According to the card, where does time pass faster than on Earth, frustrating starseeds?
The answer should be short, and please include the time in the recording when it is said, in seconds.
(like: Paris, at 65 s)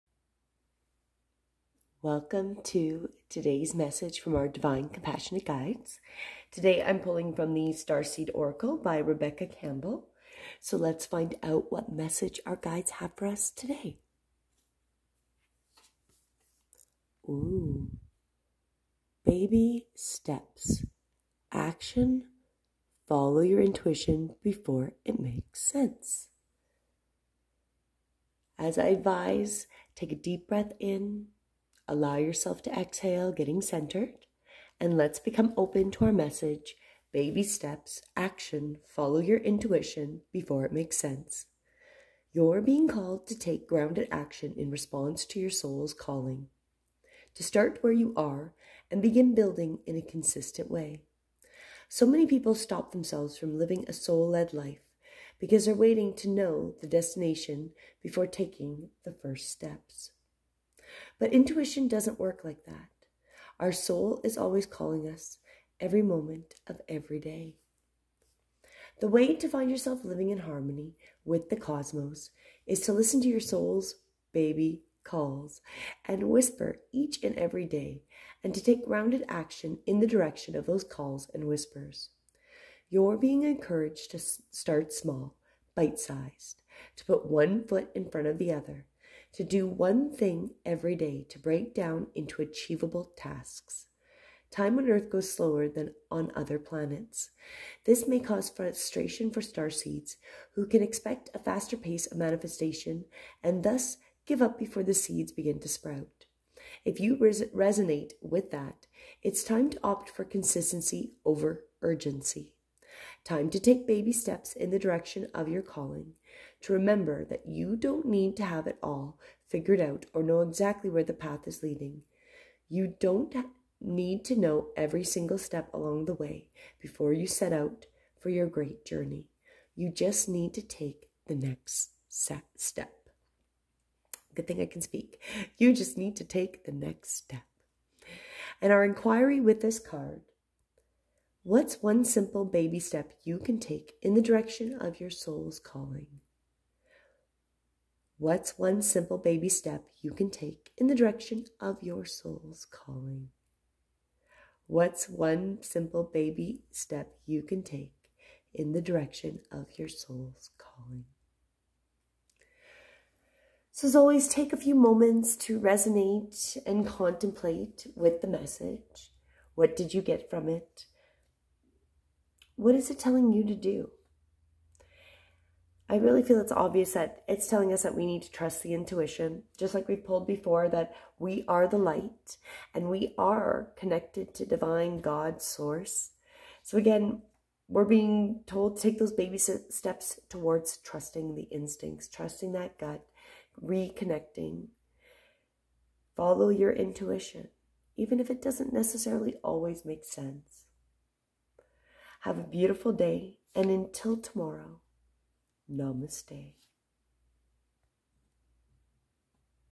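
other planets, at 96 s.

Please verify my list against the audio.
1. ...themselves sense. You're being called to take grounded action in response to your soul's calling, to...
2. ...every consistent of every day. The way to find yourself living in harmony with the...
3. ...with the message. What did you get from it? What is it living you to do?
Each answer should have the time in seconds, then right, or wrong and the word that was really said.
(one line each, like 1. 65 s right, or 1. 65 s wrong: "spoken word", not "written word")
1. 40 s wrong: "makes", not "themselves"
2. 65 s wrong: "moment", not "consistent"
3. 167 s wrong: "telling", not "living".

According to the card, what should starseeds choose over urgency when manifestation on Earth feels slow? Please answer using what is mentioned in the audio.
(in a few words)
consistency.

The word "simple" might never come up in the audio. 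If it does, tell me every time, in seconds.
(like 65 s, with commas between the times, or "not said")
142 s, 148 s, 155 s.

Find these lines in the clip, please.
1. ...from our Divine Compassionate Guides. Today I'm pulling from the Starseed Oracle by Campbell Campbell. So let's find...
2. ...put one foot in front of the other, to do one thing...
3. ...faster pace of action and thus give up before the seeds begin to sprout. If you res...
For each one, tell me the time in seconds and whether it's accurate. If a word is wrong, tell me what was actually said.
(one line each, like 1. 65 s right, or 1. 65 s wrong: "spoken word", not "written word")
1. 4 s wrong: "Rebecca", not "Campbell"
2. 87 s right
3. 101 s wrong: "manifestation", not "action".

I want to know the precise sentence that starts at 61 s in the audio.
But intuition doesn't work like that.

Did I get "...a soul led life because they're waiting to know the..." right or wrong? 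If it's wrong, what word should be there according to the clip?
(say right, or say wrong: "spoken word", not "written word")
right.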